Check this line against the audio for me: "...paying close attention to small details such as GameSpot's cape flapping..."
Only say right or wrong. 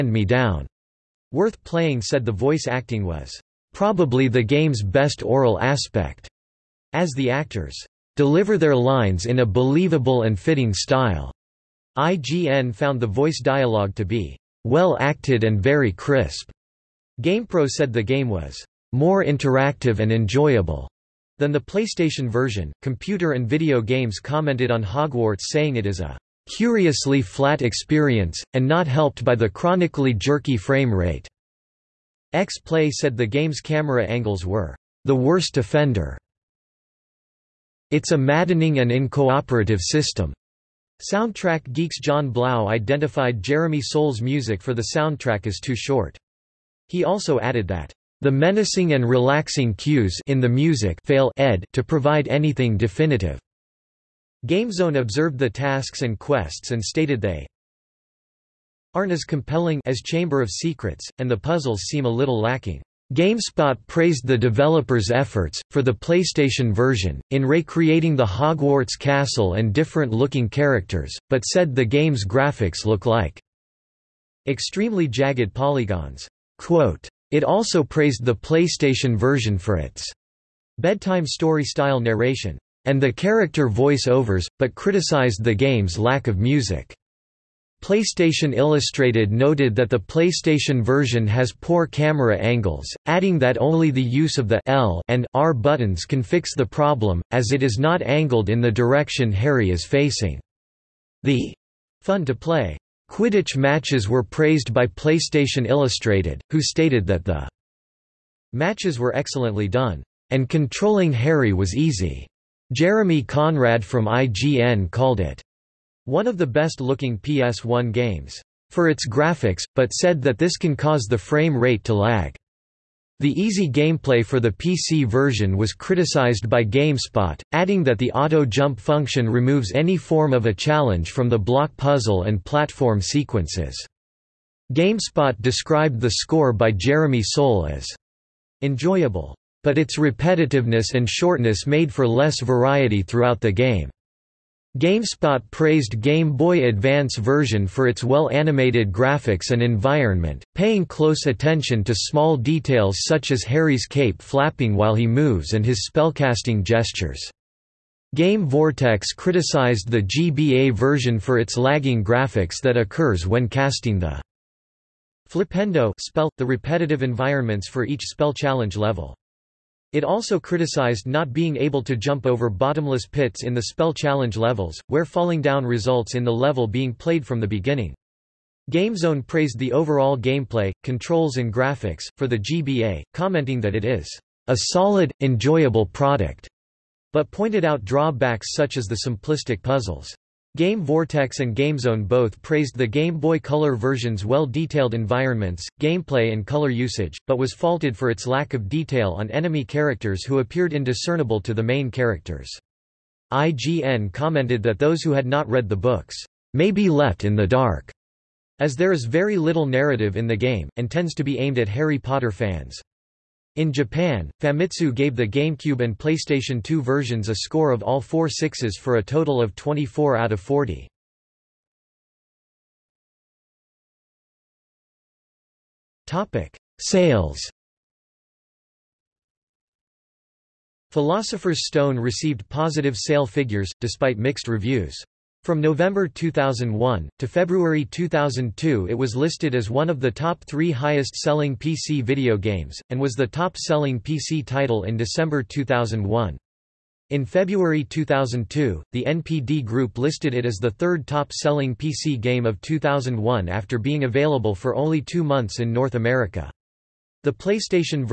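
wrong.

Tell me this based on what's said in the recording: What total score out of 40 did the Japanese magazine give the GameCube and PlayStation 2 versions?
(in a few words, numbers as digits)
24.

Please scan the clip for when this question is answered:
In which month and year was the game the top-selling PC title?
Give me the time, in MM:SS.
04:04.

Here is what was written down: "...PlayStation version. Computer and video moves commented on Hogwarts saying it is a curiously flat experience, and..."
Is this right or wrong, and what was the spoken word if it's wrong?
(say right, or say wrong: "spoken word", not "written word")
wrong: "games", not "moves".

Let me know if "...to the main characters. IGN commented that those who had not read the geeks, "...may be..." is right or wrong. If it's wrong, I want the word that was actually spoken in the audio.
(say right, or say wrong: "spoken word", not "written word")
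wrong: "books", not "geeks".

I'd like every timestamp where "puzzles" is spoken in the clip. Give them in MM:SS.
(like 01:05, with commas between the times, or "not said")
01:01, 02:11, 03:09.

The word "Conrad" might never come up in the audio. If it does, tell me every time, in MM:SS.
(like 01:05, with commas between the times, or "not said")
01:53.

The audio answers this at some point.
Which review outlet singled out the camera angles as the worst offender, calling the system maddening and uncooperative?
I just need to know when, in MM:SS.
00:32.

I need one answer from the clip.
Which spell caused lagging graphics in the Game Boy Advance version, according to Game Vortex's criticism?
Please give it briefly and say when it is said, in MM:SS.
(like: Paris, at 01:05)
Flipendo, at 02:45.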